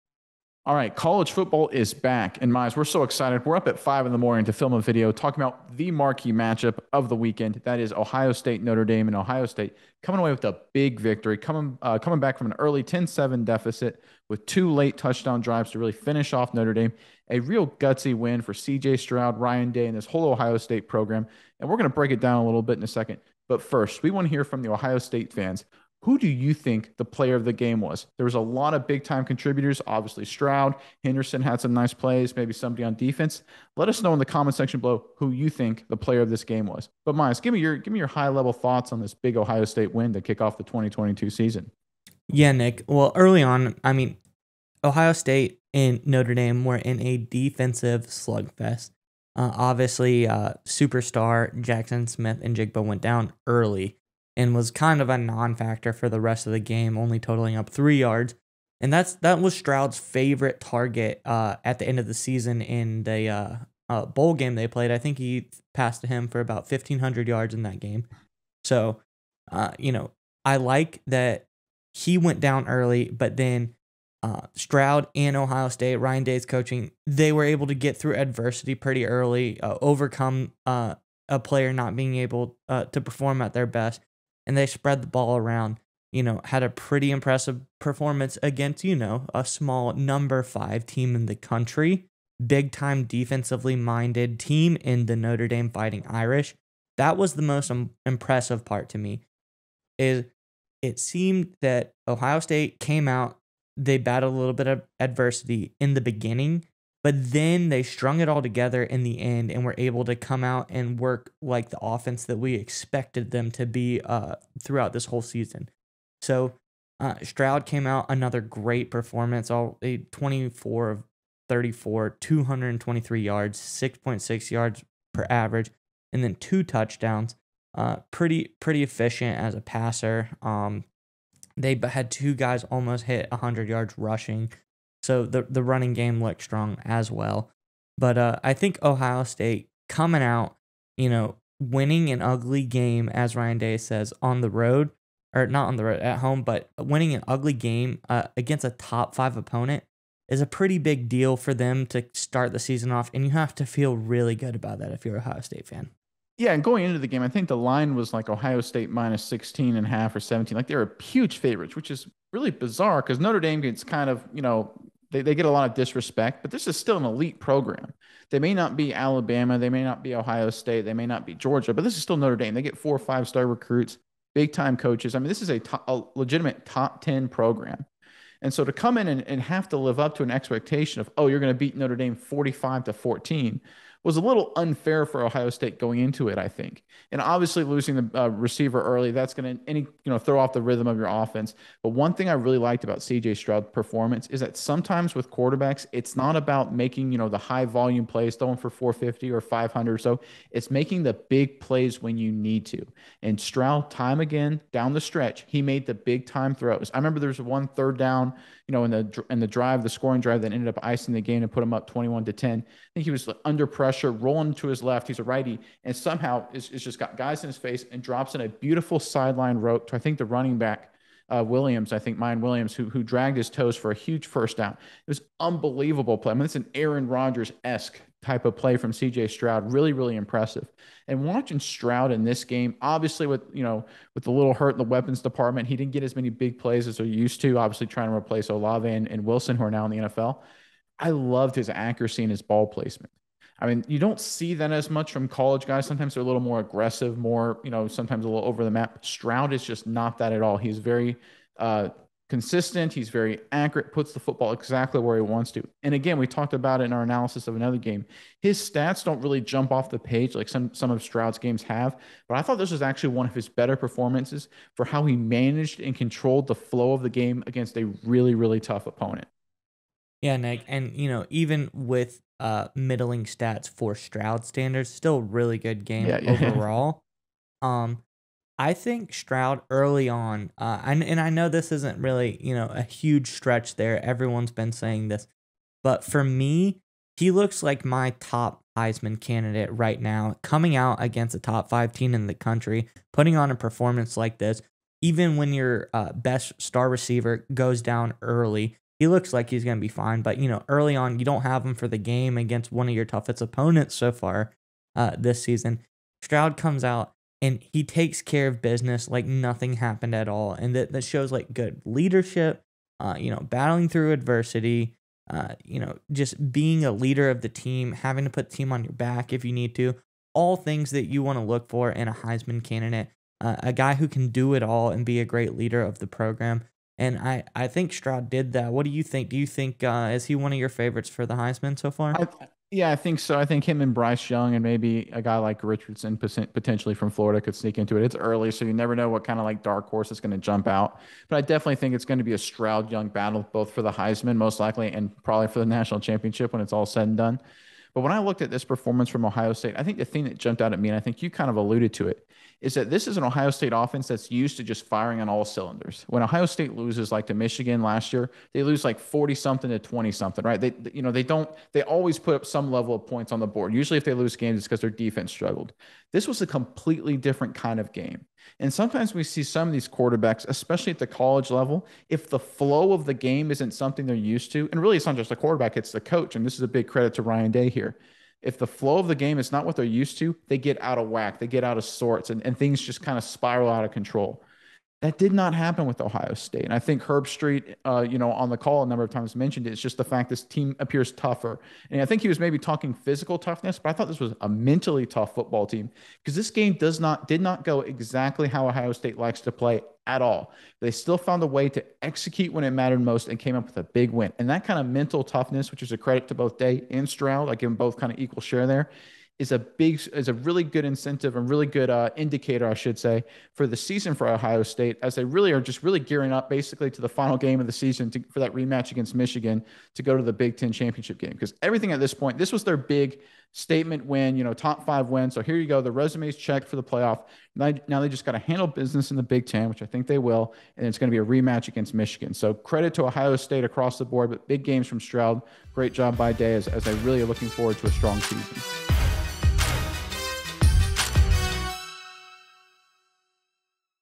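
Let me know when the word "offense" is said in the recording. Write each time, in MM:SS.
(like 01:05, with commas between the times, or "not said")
01:51, 03:11, 05:53.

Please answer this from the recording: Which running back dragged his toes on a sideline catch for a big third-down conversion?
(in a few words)
Miyan Williams.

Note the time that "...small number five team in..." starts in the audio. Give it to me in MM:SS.
01:29.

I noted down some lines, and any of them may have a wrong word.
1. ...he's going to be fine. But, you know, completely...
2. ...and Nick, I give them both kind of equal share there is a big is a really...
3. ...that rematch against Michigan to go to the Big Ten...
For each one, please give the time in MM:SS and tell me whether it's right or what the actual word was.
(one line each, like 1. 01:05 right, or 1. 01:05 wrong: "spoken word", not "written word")
1. 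04:59 wrong: "early", not "completely"
2. 06:46 wrong: "Stroud", not "Nick"
3. 06:58 right.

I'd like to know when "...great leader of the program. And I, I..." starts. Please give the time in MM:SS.
05:25.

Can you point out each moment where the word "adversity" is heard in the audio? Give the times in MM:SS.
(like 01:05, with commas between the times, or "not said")
01:18, 01:44, 05:14.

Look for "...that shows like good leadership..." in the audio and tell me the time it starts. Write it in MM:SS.
05:10.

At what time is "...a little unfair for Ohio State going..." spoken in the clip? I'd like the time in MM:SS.
03:04.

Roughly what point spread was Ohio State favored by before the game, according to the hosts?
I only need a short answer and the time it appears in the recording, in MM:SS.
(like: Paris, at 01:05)
16.5 or 17, at 02:38.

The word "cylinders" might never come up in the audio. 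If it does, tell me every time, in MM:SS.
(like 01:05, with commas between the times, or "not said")
05:55.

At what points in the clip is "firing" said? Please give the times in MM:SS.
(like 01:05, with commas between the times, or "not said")
05:54.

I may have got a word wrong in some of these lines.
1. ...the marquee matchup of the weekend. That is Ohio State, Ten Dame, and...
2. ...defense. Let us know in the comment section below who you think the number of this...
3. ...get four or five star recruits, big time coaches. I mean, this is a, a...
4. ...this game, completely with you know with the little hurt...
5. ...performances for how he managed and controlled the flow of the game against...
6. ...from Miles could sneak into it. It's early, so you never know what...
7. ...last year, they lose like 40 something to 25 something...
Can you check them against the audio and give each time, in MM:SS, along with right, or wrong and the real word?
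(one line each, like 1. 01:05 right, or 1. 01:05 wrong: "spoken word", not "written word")
1. 00:05 wrong: "Notre", not "Ten"
2. 00:32 wrong: "player", not "number"
3. 02:52 right
4. 03:52 wrong: "obviously", not "completely"
5. 04:23 right
6. 05:36 wrong: "Florida", not "Miles"
7. 05:57 wrong: "20", not "25".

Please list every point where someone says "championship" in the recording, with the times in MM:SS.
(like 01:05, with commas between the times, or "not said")
05:45, 07:00.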